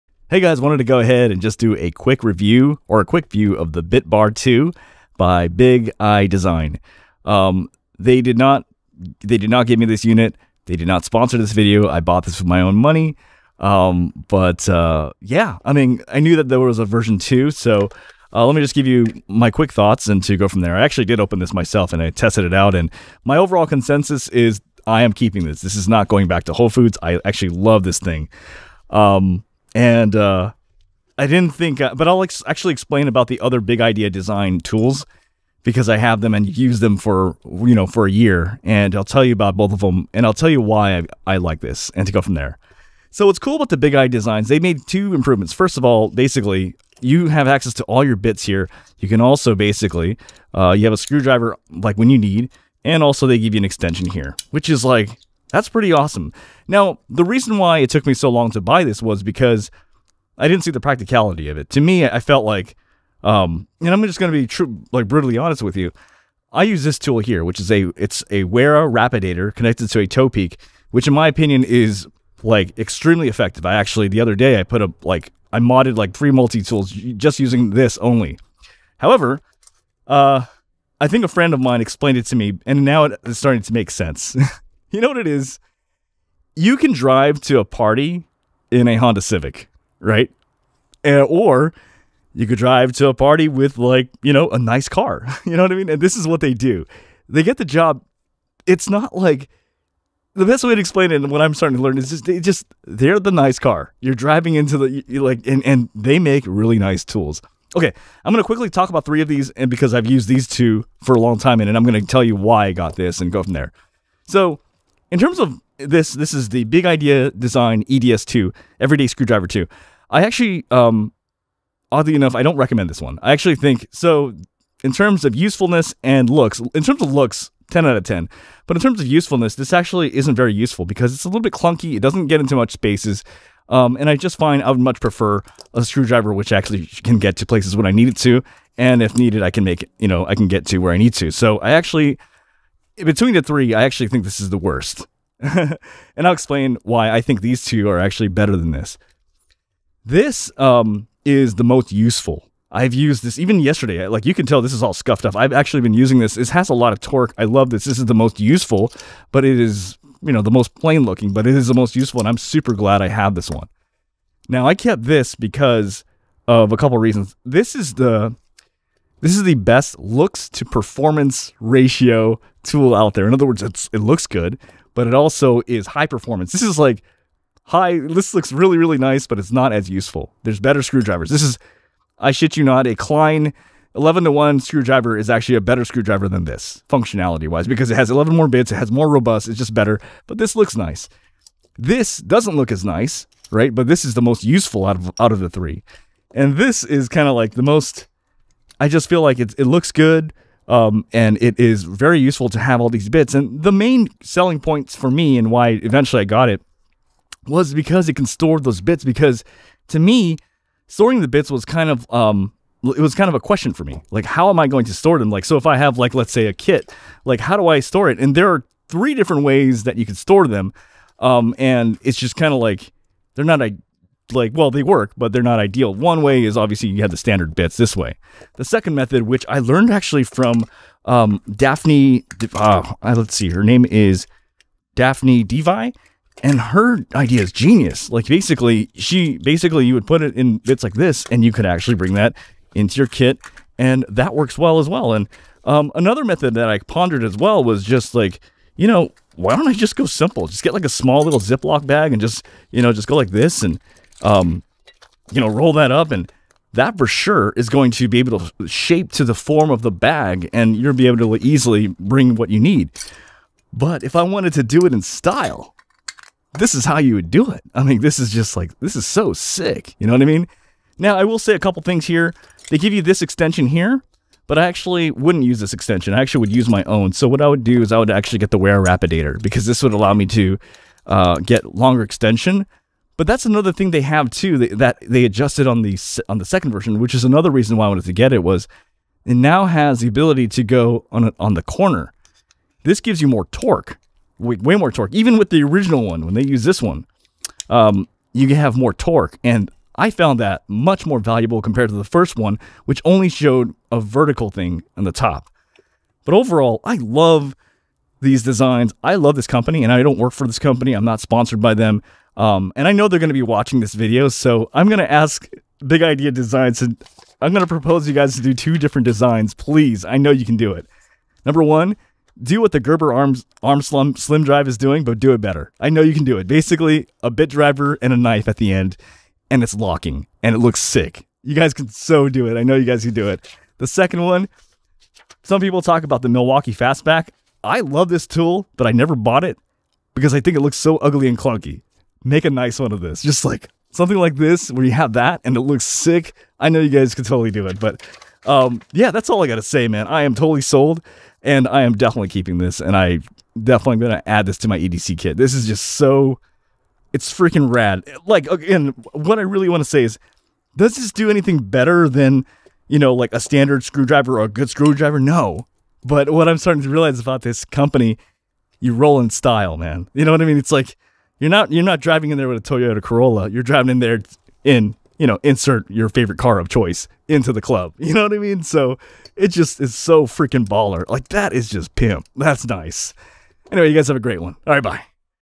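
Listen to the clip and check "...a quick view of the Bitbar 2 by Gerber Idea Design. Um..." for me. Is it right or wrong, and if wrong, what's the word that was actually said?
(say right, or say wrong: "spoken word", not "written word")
wrong: "Big", not "Gerber".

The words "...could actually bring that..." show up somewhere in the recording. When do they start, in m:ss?
4:01.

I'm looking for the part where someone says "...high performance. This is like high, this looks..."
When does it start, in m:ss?
2:55.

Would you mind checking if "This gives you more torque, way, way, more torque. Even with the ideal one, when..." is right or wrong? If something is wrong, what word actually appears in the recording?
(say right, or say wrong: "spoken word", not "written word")
wrong: "original", not "ideal".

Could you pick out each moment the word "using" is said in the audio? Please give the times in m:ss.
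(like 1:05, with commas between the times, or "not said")
1:17, 2:35.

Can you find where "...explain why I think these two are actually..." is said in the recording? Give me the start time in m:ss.
2:26.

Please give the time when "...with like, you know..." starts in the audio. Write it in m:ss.
1:33.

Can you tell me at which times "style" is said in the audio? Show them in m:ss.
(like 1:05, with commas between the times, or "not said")
4:25, 6:09.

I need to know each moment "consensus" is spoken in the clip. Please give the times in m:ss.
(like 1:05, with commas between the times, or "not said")
0:23.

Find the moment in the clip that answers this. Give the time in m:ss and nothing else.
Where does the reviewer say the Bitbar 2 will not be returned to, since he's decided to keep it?
0:26.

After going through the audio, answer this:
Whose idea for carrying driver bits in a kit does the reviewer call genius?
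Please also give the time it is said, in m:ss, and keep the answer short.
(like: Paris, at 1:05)
Daphne Devi, at 3:54.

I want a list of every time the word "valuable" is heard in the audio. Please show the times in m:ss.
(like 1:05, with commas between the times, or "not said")
5:01.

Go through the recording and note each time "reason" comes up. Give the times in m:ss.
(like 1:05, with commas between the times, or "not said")
0:57, 2:46, 4:47.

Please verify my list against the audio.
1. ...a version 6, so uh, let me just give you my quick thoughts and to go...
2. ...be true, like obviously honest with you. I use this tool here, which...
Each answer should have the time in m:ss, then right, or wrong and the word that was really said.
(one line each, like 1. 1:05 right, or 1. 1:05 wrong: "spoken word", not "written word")
1. 0:16 wrong: "2", not "6"
2. 1:04 wrong: "brutally", not "obviously".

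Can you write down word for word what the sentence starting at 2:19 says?
You know, I can get to where I need to.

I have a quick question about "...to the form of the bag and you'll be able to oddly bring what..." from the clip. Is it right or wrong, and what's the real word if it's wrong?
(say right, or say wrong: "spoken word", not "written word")
wrong: "easily", not "oddly".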